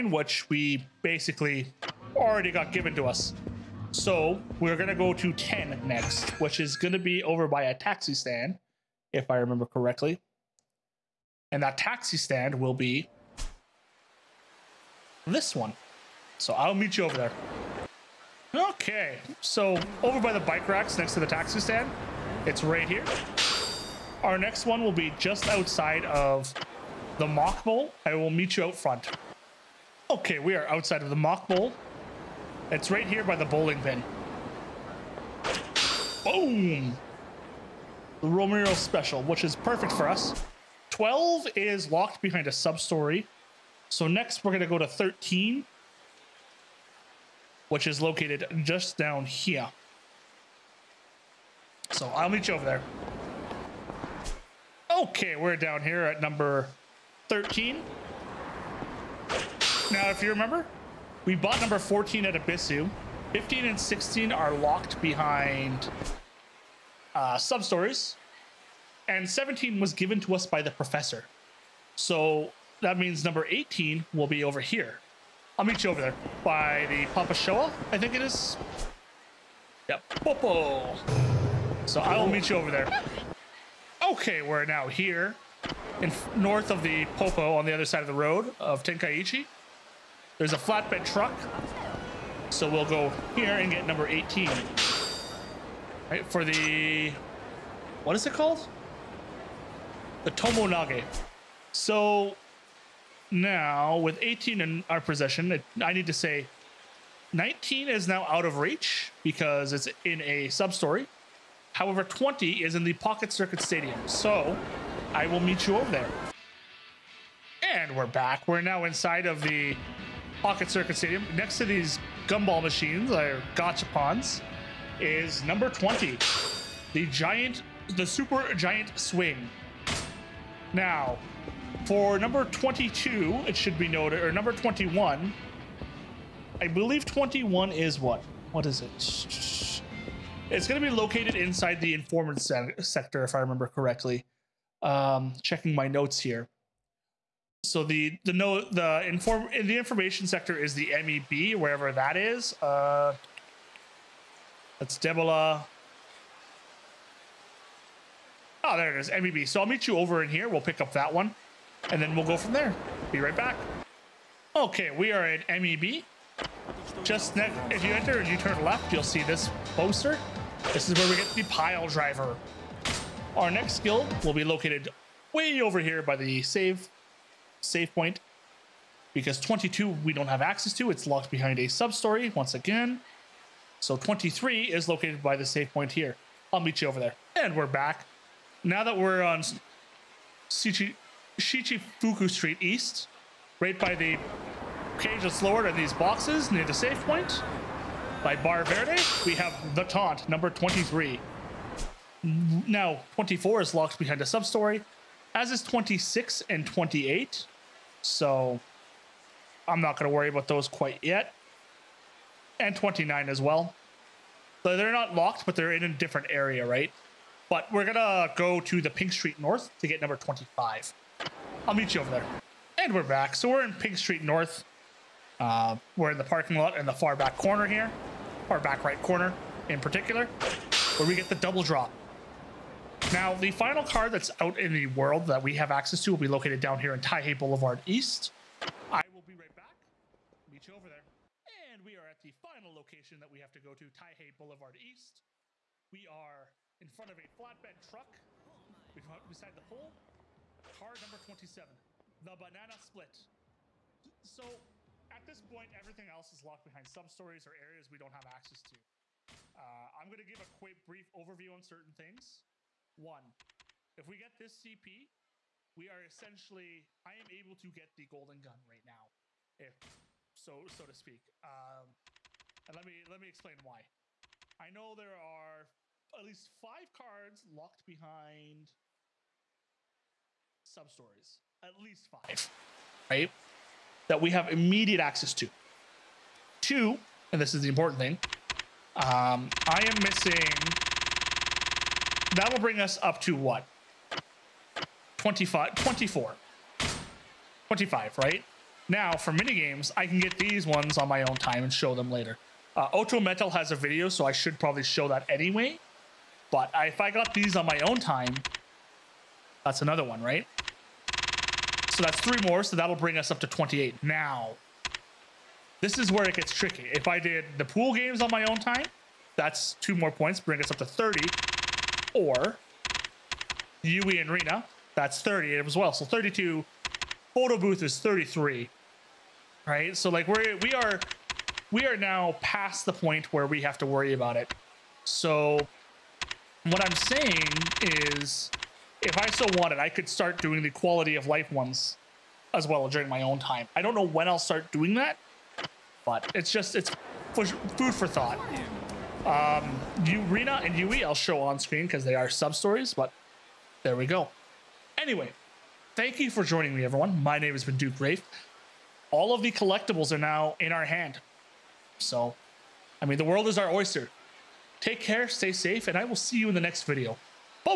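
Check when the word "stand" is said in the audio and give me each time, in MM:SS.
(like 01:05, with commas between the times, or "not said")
00:08, 00:12, 00:21.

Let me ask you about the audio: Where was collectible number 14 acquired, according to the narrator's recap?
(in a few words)
Ebisu.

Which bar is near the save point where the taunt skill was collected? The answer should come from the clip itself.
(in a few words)
Bar Verde.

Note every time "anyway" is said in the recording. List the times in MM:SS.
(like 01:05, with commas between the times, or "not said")
05:05, 05:54.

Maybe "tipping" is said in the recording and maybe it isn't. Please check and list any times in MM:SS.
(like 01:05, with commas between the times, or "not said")
not said.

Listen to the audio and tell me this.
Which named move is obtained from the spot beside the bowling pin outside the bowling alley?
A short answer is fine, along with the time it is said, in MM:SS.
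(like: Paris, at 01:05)
The Romero special, at 00:38.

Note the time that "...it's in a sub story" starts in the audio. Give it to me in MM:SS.
01:49.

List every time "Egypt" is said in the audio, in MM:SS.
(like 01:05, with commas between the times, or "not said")
not said.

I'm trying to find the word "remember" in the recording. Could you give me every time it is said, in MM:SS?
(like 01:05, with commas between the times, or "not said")
00:09, 01:00, 02:23.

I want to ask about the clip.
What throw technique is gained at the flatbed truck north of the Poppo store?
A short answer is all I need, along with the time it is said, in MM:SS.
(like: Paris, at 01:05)
Tomoe Nage, at 01:40.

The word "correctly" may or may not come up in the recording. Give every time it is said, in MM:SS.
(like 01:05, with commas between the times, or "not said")
00:09, 02:23.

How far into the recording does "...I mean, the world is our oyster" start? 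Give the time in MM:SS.
06:03.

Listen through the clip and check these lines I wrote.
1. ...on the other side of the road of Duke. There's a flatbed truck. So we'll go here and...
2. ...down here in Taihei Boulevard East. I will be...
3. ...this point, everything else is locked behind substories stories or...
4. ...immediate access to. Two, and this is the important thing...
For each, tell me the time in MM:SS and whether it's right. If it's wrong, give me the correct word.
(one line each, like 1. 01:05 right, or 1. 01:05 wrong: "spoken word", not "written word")
1. 01:27 wrong: "Tenkaichi", not "Duke"
2. 03:56 right
3. 04:15 right
4. 04:44 right.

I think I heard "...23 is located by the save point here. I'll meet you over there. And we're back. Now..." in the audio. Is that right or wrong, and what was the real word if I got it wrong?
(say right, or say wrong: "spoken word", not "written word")
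right.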